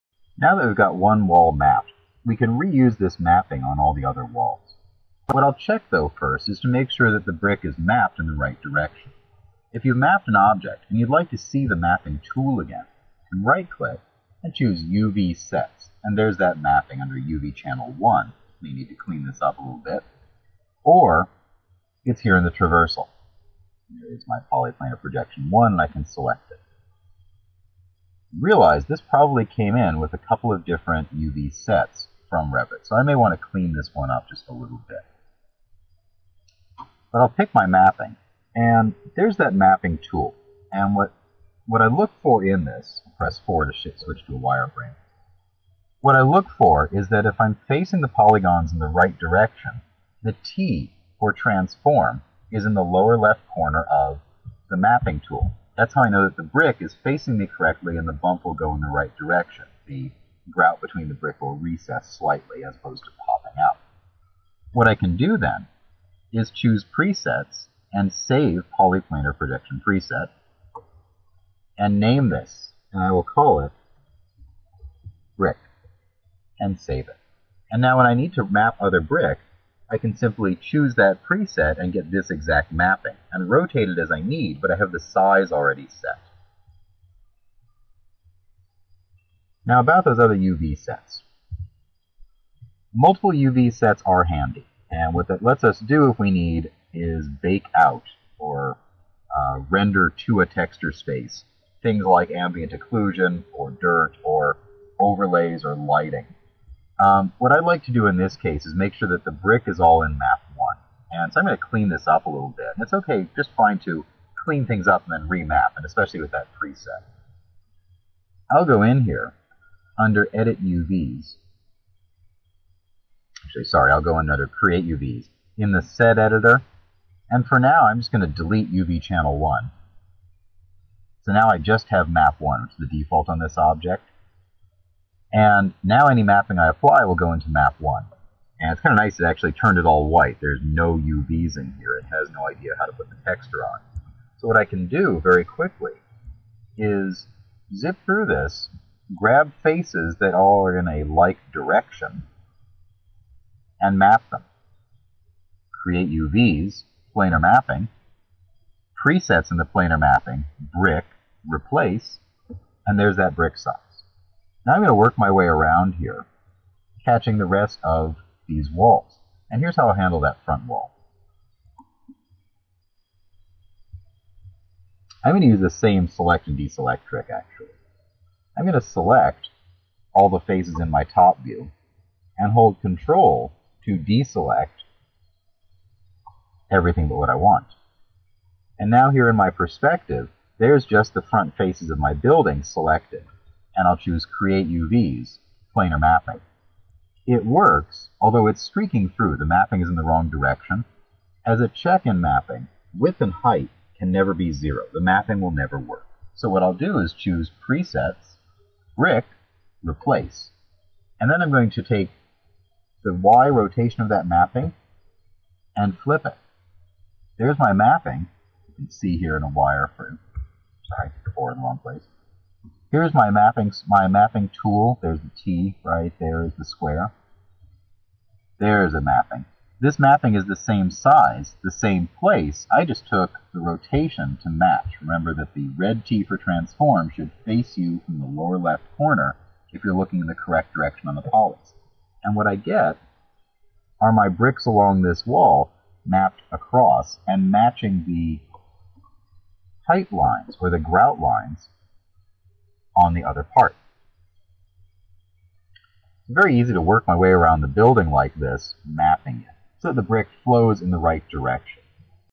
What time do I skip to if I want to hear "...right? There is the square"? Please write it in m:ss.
3:45.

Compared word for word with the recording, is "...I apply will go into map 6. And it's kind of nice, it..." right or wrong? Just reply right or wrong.
wrong.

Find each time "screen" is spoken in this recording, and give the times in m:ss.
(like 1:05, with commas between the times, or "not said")
not said.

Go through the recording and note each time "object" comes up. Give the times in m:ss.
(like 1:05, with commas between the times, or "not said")
0:10, 2:13.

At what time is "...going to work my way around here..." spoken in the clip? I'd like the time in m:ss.
2:44.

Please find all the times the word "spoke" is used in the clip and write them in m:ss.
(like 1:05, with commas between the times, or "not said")
not said.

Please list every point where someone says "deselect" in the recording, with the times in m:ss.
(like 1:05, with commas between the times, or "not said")
2:56, 3:03.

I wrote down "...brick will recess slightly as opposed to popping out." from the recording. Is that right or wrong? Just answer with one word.
right.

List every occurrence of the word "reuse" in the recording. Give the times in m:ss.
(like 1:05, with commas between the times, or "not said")
0:02.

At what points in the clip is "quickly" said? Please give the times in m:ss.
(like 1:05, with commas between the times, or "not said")
2:25.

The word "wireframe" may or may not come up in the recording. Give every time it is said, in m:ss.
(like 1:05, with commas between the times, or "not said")
0:44, 3:39.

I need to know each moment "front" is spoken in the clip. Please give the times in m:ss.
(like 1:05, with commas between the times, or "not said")
2:50, 3:11.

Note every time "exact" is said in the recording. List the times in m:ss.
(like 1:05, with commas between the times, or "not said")
1:22.